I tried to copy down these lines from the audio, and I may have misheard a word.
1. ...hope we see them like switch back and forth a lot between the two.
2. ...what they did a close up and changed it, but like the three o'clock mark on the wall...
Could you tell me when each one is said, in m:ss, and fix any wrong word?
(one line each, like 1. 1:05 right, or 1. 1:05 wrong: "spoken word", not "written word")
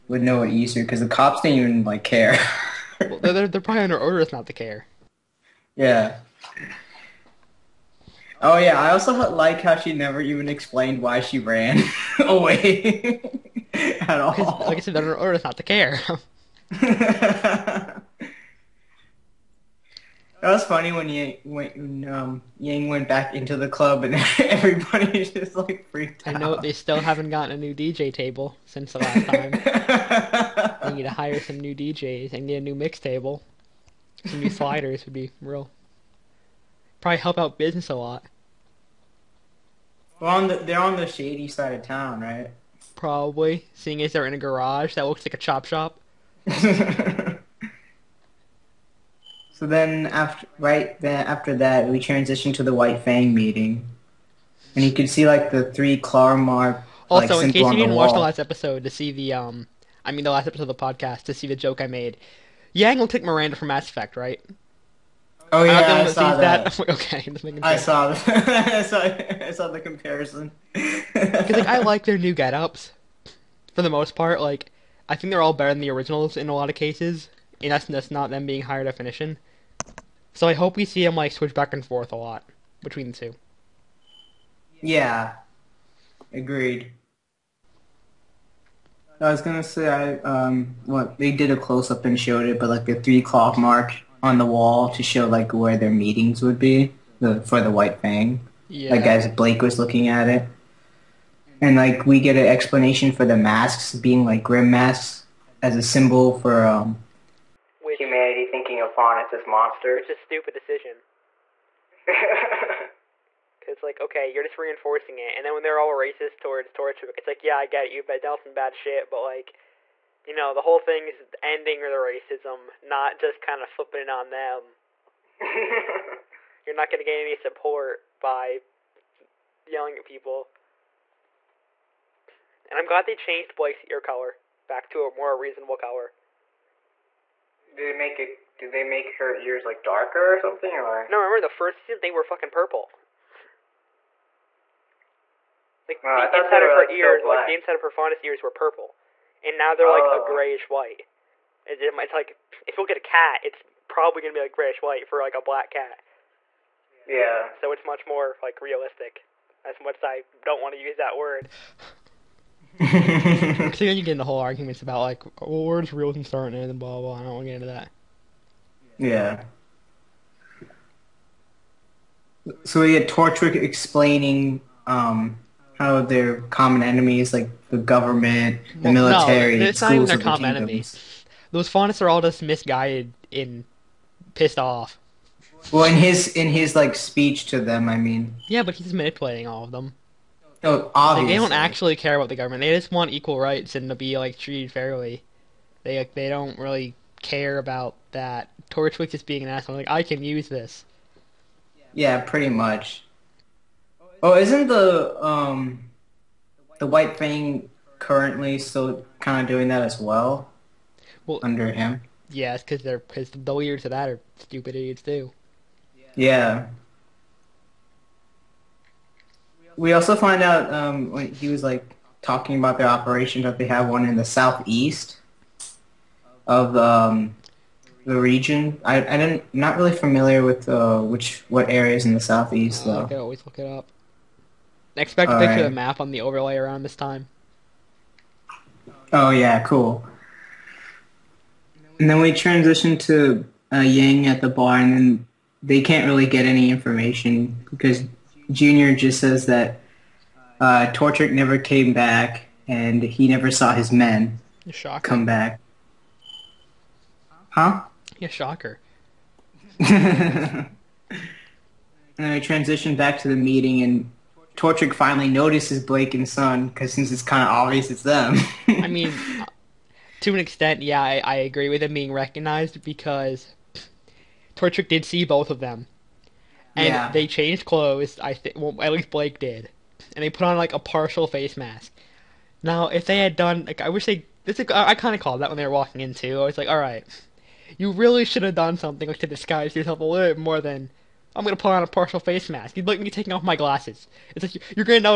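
1. 1:20 right
2. 1:30 wrong: "showed", not "changed".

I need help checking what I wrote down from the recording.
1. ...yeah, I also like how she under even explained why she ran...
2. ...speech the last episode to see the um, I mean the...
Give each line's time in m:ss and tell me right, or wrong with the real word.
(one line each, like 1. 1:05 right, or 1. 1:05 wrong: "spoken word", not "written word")
1. 0:08 wrong: "never", not "under"
2. 0:57 wrong: "watch", not "speech".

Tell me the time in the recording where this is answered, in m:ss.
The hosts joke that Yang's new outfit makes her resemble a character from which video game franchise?
1:03.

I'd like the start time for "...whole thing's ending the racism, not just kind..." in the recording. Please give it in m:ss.
2:00.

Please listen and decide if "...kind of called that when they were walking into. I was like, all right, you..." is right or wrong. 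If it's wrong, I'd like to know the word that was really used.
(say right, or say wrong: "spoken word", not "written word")
right.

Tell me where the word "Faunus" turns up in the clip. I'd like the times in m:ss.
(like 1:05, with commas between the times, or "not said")
1:48, 2:27, 3:01.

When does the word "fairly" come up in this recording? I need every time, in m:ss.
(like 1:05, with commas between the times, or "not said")
3:14.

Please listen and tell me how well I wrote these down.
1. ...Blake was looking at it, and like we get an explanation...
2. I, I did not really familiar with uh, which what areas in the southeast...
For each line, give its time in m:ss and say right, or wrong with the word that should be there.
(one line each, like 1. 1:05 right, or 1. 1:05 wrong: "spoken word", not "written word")
1. 1:39 right
2. 3:48 right.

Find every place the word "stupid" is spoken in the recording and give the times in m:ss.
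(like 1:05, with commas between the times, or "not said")
1:50, 3:34.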